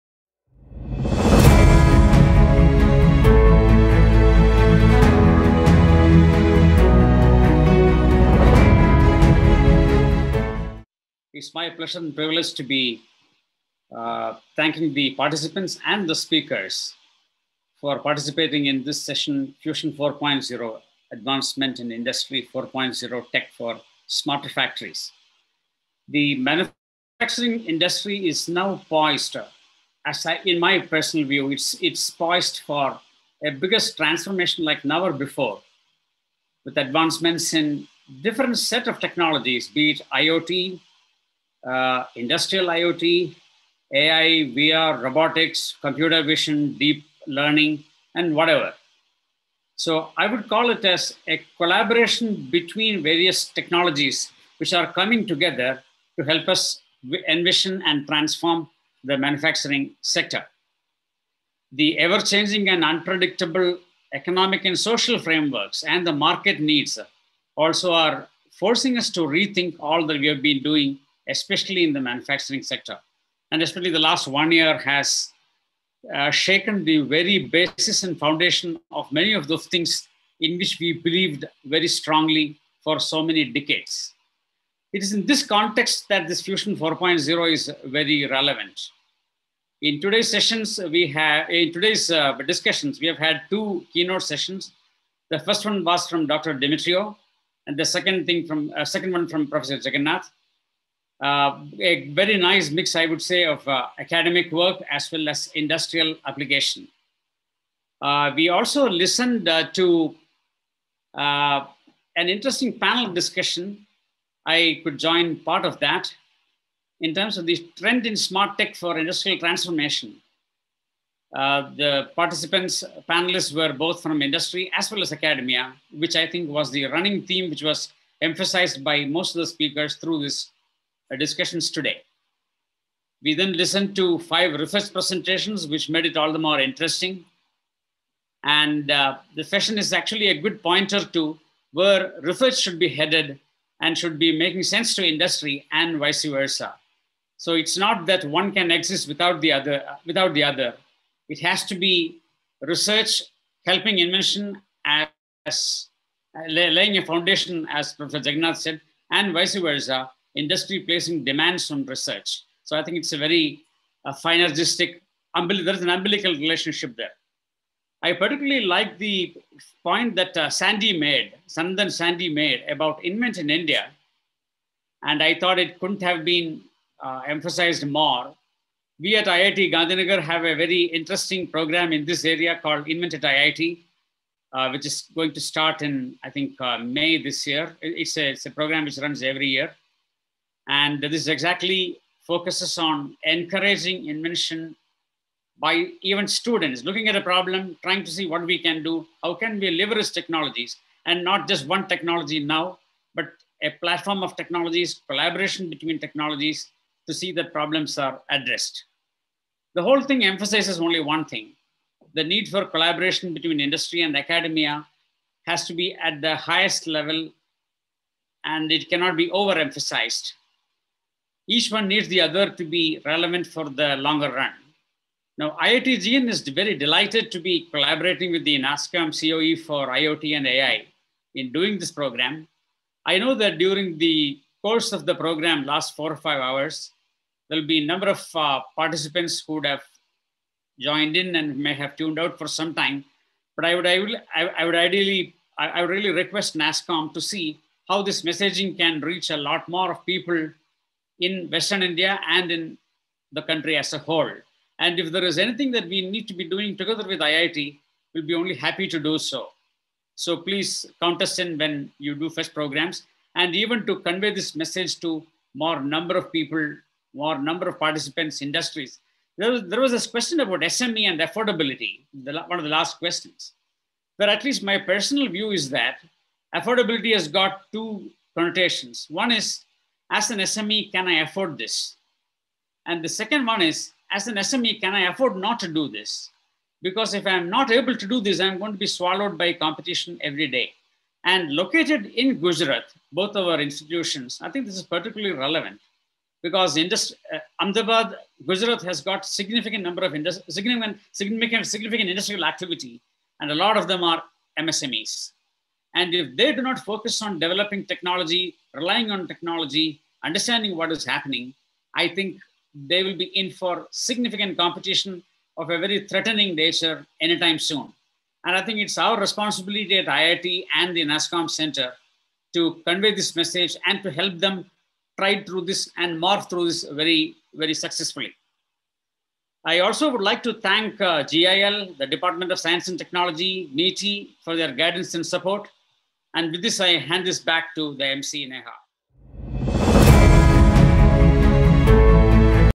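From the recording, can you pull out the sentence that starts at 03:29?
The whole thing emphasizes only one thing.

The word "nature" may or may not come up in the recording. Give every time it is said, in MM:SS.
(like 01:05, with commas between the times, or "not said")
05:16.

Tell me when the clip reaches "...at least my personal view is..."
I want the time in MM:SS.
04:34.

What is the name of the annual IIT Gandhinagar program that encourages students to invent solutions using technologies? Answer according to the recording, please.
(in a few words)
Invent at IIT.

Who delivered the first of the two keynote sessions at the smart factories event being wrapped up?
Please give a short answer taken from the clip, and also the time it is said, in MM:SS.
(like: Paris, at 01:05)
Dr. Demetrio, at 01:36.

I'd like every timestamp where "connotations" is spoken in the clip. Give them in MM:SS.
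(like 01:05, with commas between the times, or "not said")
04:38.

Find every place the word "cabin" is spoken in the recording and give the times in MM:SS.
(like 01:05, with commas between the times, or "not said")
not said.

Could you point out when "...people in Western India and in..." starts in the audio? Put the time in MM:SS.
04:10.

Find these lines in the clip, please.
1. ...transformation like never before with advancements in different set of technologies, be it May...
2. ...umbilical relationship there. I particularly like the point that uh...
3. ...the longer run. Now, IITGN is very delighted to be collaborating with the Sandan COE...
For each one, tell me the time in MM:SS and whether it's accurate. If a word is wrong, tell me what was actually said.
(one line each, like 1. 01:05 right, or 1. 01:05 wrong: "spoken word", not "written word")
1. 00:33 wrong: "IoT", not "May"
2. 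02:45 right
3. 03:43 wrong: "NASSCOM", not "Sandan".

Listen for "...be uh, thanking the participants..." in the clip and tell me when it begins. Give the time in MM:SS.
00:12.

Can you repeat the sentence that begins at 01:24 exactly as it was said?
It is in this context that this Fusion 4.0 is very relevant.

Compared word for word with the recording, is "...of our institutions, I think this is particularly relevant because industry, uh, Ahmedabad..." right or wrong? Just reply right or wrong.
right.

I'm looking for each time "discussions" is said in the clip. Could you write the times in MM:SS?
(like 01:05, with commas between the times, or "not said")
01:32, 01:53, 02:11.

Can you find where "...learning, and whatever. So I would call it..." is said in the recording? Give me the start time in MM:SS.
00:47.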